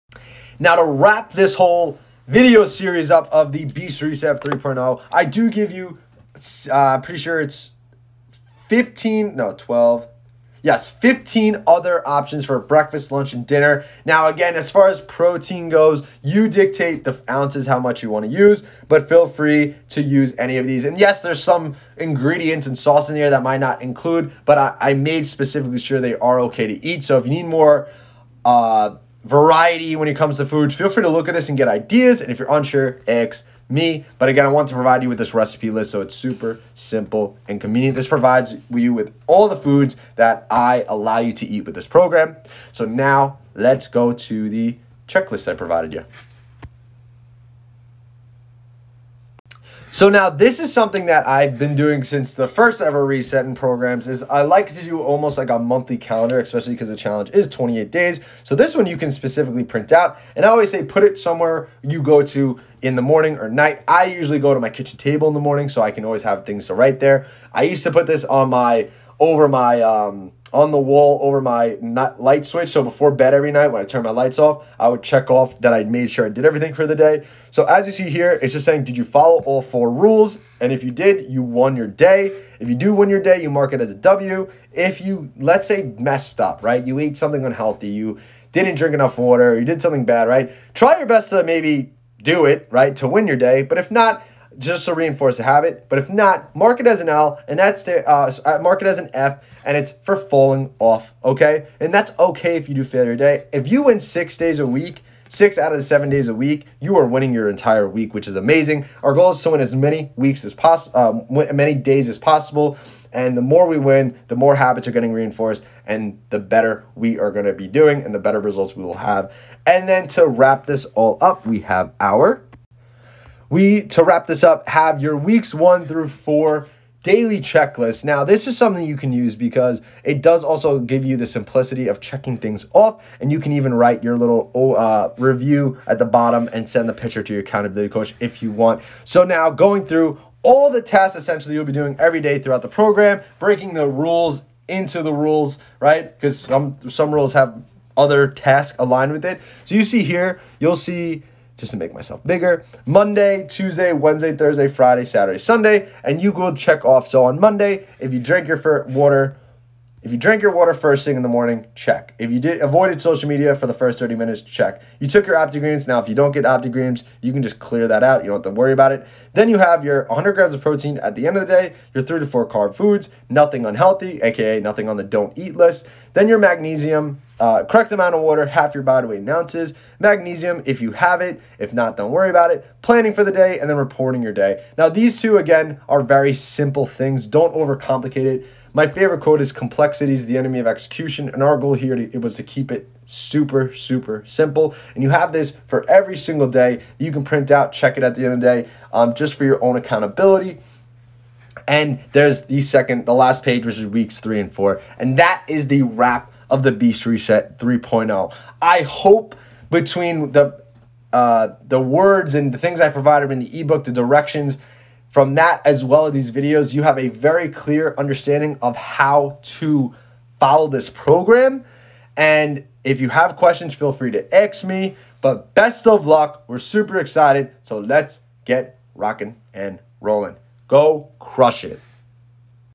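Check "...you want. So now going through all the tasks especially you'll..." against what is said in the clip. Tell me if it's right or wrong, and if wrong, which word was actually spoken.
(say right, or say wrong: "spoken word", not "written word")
wrong: "essentially", not "especially".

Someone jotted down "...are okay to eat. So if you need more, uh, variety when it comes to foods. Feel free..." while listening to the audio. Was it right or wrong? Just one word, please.
right.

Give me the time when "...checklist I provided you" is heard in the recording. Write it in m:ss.
0:45.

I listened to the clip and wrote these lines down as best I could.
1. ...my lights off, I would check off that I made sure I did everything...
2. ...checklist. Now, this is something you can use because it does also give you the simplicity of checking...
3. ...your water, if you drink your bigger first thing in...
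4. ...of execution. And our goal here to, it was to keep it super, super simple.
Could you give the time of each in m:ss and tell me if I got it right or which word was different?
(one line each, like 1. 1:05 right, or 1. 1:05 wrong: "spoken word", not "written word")
1. 1:14 right
2. 2:07 right
3. 2:38 wrong: "water", not "bigger"
4. 3:10 right.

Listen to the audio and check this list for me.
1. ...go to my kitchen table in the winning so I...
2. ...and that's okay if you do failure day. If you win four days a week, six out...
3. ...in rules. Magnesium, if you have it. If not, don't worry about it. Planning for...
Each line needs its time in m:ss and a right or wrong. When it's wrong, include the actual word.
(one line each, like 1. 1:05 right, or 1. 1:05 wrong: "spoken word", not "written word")
1. 1:04 wrong: "morning", not "winning"
2. 1:41 wrong: "six", not "four"
3. 2:59 wrong: "ounces", not "rules".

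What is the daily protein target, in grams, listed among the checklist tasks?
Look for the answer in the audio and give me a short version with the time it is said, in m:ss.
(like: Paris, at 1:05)
100 grams, at 2:50.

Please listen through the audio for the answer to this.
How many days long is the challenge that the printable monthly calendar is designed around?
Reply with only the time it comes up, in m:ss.
0:57.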